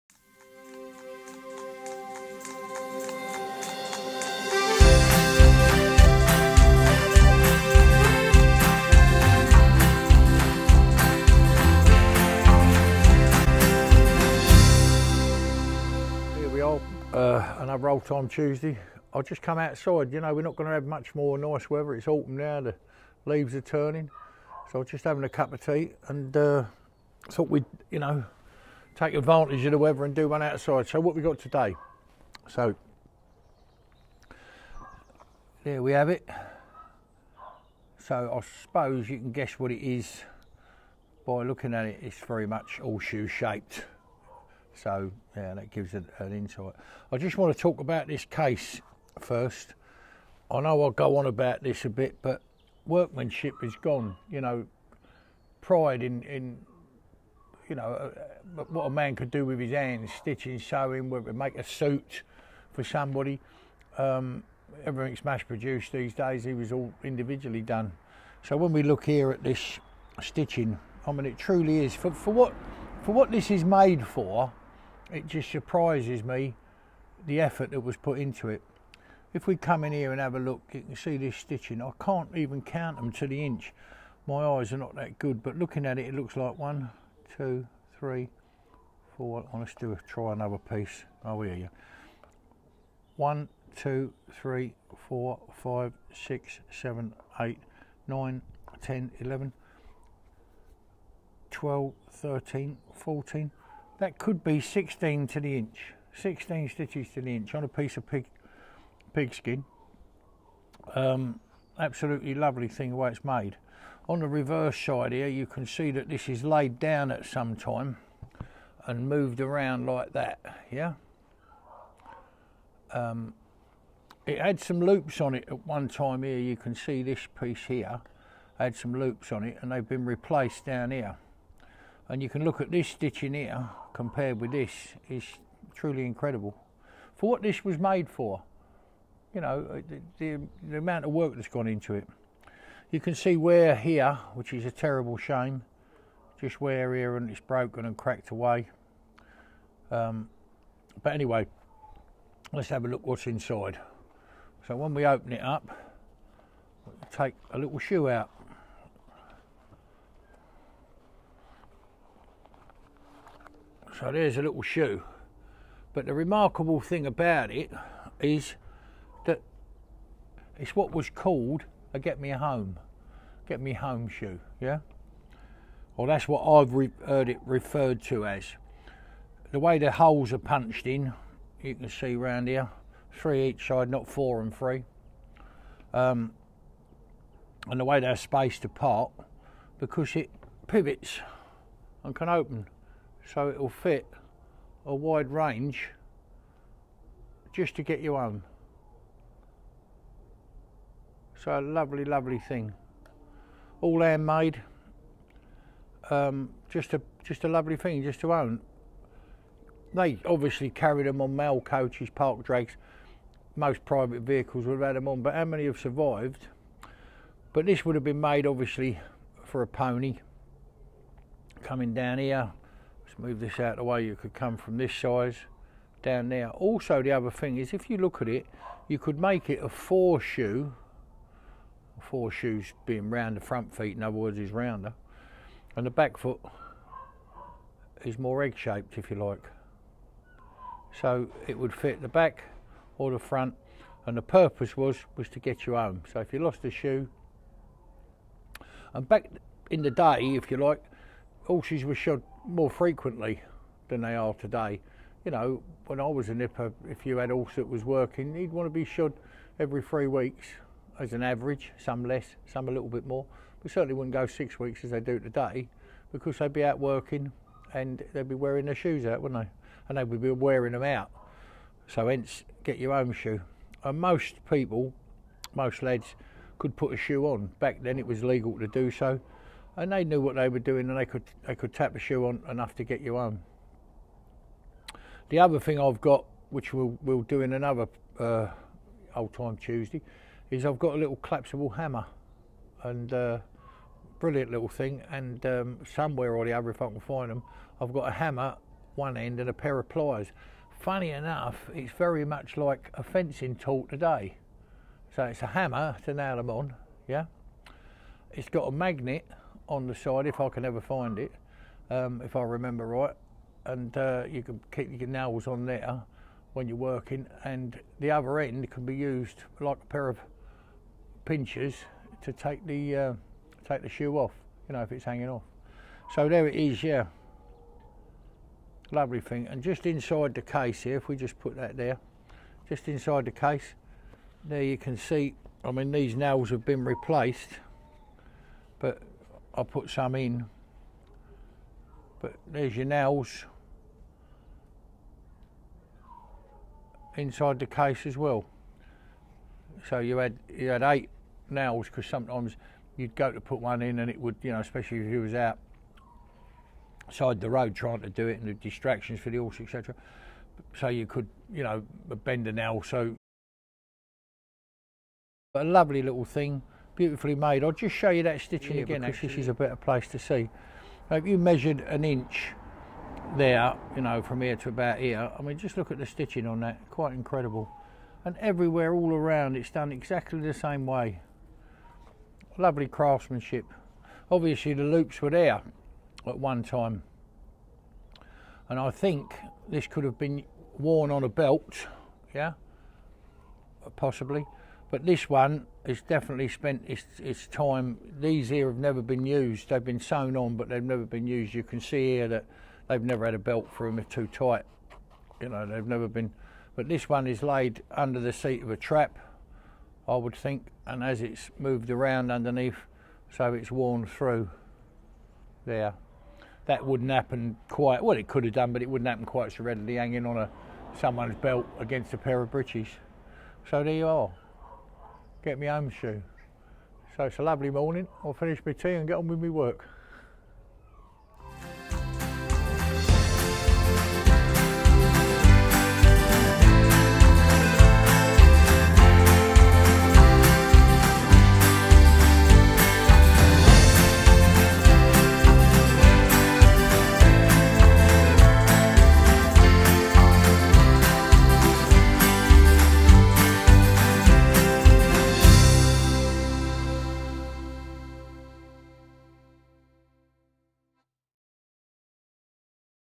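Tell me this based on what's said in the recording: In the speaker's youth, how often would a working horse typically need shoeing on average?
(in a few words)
Every 3 weeks.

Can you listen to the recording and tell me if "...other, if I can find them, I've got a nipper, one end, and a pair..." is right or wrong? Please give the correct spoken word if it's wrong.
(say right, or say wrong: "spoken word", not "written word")
wrong: "hammer", not "nipper".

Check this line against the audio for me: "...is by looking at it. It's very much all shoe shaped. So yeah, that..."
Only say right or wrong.
right.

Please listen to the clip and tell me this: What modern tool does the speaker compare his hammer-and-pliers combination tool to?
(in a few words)
Fencing tool.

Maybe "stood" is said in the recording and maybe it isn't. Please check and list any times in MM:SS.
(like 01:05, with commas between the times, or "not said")
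not said.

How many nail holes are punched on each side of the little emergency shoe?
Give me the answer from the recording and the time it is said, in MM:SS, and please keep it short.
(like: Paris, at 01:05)
3, at 03:03.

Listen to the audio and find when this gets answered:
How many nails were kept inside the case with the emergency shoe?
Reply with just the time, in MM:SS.
05:50.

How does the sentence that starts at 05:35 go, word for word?
I mean these nails have been replaced, but I put some in.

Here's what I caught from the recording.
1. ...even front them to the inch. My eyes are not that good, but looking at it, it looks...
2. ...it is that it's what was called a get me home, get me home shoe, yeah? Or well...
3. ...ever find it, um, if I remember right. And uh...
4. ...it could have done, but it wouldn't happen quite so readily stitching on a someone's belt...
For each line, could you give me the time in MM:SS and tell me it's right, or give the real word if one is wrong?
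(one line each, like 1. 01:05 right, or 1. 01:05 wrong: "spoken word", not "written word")
1. 01:22 wrong: "count", not "front"
2. 02:47 right
3. 05:10 right
4. 06:58 wrong: "hanging", not "stitching".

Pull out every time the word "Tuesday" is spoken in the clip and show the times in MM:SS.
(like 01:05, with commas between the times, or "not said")
00:18, 04:49.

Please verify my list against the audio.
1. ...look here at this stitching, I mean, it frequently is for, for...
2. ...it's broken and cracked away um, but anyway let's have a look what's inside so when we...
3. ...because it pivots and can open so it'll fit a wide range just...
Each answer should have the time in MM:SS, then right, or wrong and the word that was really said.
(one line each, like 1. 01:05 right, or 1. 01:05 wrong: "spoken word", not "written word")
1. 01:08 wrong: "truly", not "frequently"
2. 02:27 right
3. 03:09 right.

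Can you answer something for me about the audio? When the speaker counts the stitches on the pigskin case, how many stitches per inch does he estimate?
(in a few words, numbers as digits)
16.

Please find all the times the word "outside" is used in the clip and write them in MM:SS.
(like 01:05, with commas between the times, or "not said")
00:19, 00:30.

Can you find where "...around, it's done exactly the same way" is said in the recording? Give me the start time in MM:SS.
06:19.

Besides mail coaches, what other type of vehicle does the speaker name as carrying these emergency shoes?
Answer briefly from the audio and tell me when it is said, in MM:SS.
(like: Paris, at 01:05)
Park drags, at 03:32.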